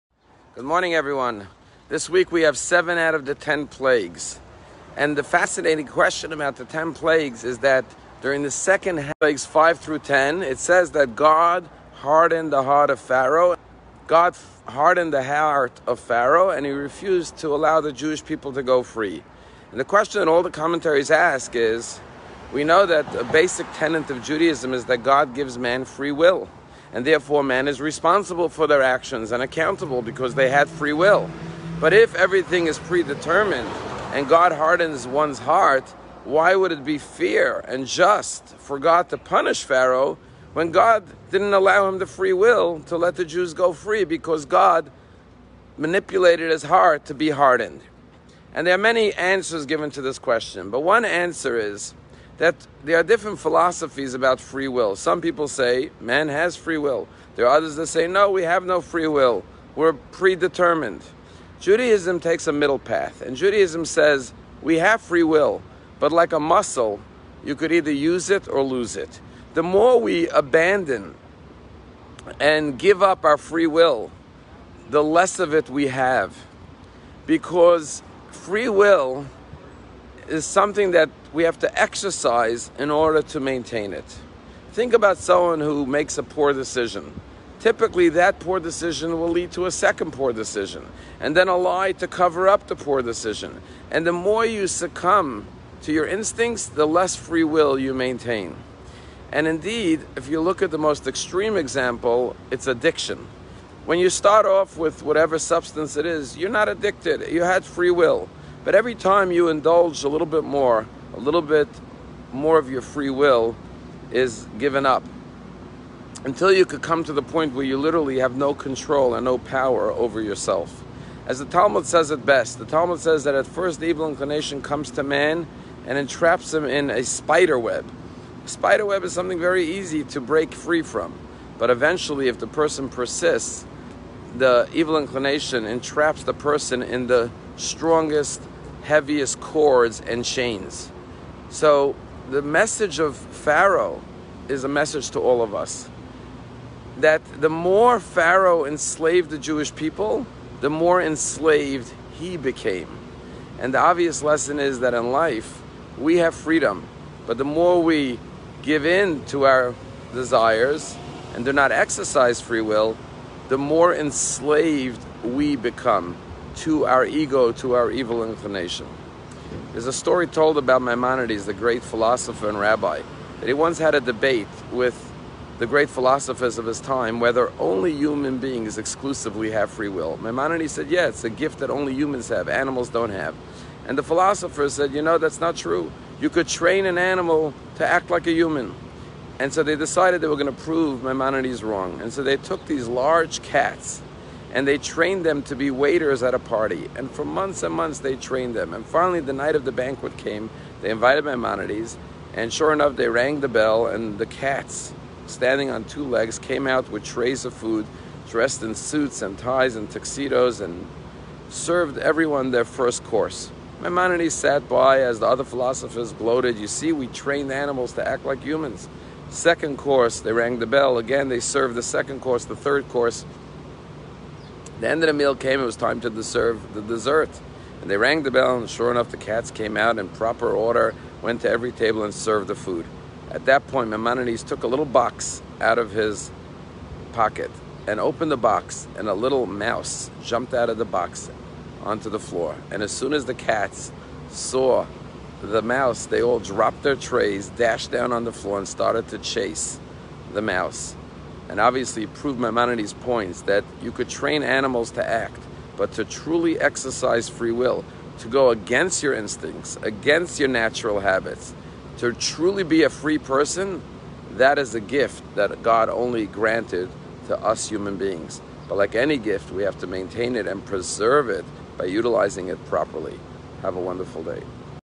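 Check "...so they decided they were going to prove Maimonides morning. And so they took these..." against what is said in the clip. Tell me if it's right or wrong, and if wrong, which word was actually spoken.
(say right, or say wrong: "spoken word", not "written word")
wrong: "wrong", not "morning".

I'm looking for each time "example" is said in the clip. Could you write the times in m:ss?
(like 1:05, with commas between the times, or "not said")
1:41.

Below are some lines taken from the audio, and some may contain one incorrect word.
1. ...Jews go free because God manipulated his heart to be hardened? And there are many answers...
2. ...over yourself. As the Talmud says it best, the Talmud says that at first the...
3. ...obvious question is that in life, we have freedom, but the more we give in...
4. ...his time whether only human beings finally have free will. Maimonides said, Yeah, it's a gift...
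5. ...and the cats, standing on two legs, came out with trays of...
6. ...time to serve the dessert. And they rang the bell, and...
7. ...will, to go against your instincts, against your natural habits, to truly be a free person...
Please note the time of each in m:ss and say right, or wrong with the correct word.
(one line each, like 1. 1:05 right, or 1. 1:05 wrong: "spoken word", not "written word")
1. 0:43 right
2. 1:59 right
3. 2:33 wrong: "lesson", not "question"
4. 2:56 wrong: "exclusively", not "finally"
5. 3:23 right
6. 3:45 right
7. 4:17 right.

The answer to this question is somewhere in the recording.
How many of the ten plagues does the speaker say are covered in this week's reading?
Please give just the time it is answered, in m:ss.
0:02.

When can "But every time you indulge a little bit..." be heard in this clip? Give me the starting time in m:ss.
1:48.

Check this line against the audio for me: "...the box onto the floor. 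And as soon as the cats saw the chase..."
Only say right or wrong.
wrong.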